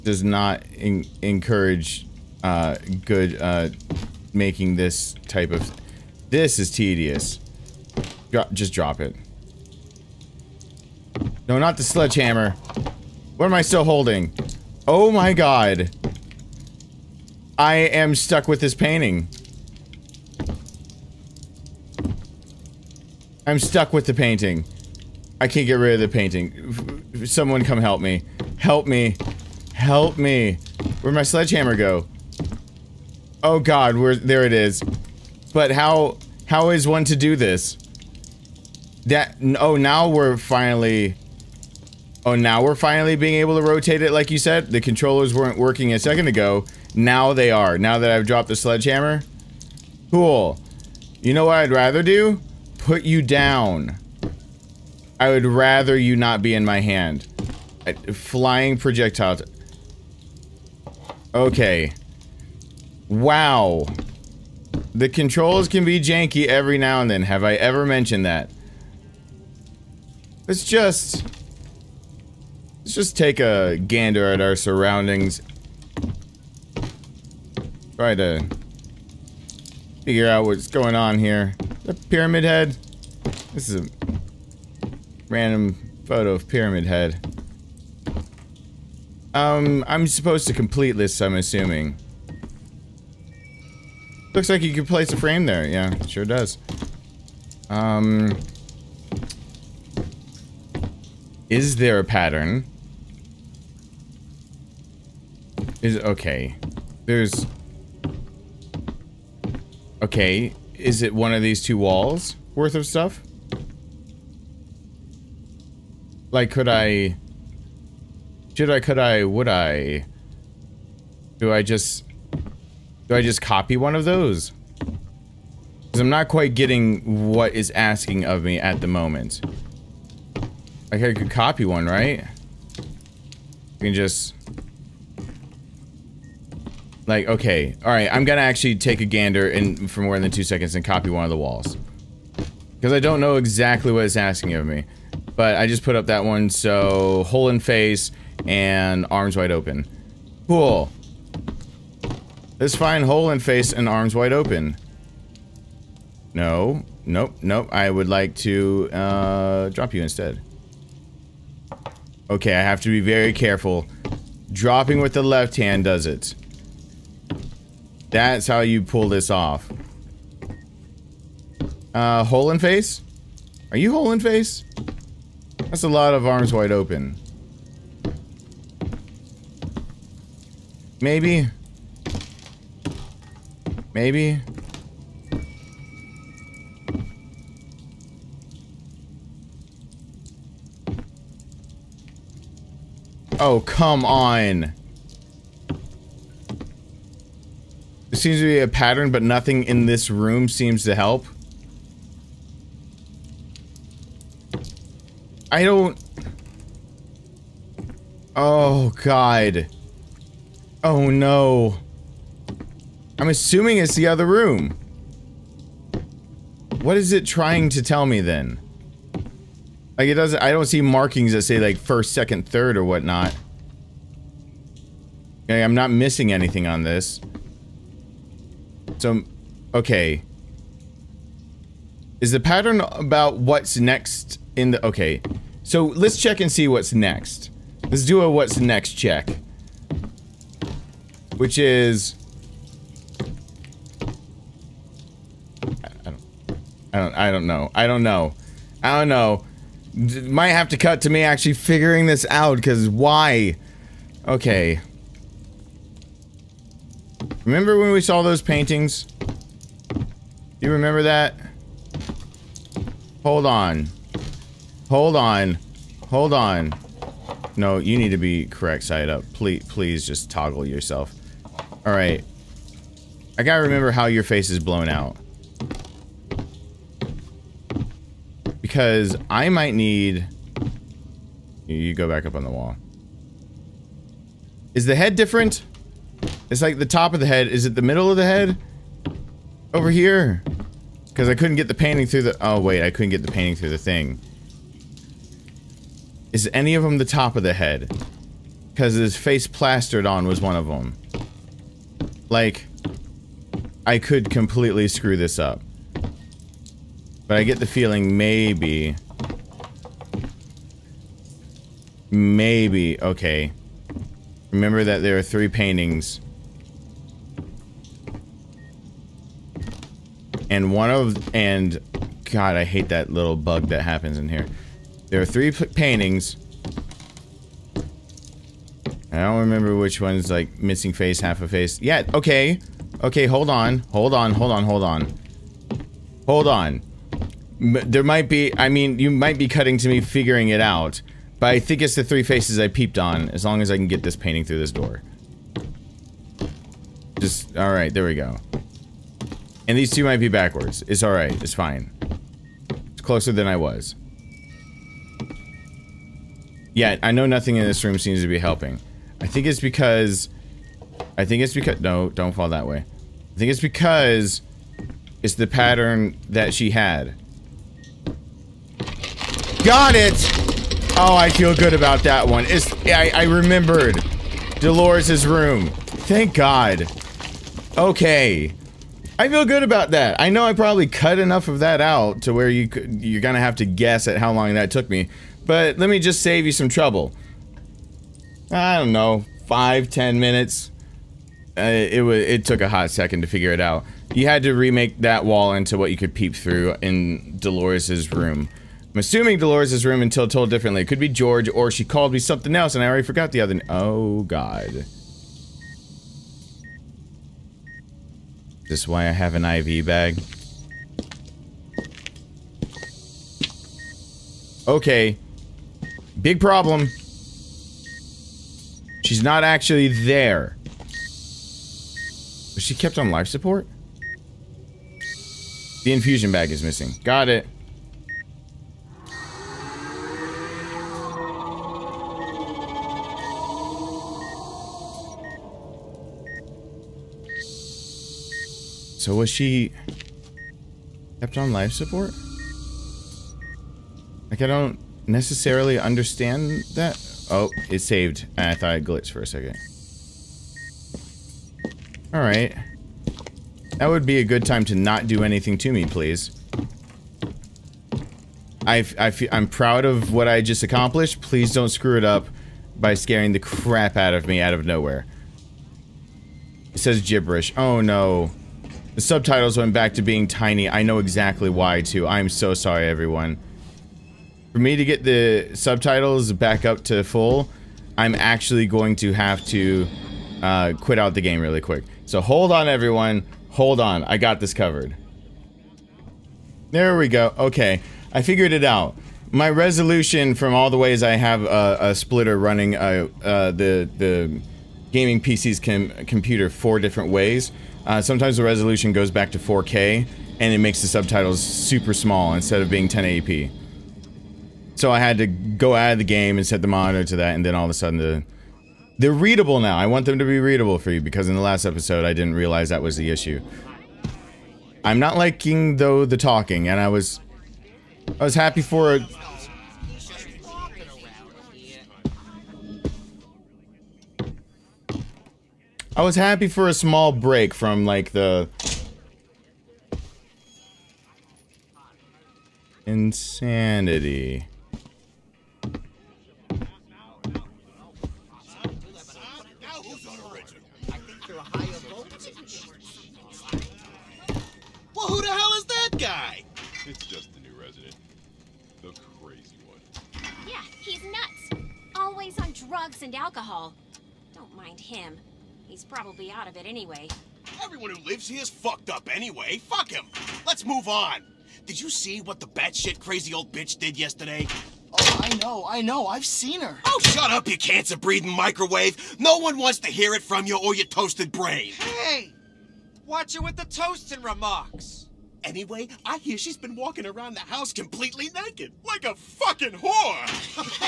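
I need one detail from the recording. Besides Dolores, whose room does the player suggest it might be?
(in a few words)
George.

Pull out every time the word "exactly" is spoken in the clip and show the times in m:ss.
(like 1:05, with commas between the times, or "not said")
2:23, 7:50.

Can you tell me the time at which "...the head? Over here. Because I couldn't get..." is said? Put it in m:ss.
4:48.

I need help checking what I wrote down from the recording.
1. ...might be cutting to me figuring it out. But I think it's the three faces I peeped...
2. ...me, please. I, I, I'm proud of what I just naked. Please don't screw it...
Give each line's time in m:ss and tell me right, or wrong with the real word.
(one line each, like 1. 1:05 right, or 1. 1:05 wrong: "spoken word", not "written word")
1. 5:39 right
2. 7:35 wrong: "accomplished", not "naked".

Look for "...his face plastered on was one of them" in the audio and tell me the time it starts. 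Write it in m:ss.
4:58.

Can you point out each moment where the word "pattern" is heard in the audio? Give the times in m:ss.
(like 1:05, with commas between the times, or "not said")
1:42, 3:18, 3:52, 6:05.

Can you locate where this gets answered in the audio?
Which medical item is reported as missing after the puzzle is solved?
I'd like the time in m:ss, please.
7:05.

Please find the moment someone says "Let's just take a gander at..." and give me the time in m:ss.
1:12.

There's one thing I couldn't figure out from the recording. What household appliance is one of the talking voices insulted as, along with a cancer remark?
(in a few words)
microwave.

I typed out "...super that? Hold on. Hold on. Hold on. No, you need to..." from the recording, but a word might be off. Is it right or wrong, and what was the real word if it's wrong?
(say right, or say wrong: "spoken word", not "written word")
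wrong: "remember", not "super".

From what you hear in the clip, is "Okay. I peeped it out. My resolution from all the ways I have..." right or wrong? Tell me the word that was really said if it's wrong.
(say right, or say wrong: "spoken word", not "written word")
wrong: "figured", not "peeped".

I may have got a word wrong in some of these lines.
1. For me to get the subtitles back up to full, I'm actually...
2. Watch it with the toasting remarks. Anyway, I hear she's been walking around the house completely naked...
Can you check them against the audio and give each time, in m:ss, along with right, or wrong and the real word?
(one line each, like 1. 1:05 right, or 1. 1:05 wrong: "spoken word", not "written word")
1. 7:54 right
2. 9:33 right.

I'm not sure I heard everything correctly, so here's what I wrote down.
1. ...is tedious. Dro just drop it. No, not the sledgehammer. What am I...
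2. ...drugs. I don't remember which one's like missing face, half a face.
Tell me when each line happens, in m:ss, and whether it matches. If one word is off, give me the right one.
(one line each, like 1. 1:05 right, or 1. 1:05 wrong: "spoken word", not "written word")
1. 0:06 right
2. 5:25 wrong: "paintings", not "drugs".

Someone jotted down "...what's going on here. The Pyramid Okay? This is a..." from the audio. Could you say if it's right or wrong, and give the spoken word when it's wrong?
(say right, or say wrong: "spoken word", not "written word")
wrong: "Head", not "Okay".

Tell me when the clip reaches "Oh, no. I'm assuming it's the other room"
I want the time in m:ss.
3:30.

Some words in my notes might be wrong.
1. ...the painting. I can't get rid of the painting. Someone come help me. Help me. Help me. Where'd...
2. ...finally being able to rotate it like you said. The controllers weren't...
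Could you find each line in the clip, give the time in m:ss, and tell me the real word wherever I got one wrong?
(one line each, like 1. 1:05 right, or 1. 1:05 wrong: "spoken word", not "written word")
1. 0:24 right
2. 0:42 right.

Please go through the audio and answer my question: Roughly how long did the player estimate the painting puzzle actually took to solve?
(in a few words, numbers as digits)
five, ten minutes.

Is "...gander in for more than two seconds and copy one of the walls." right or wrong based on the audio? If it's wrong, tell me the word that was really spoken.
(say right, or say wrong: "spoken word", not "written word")
right.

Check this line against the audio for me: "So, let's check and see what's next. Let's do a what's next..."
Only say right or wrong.
right.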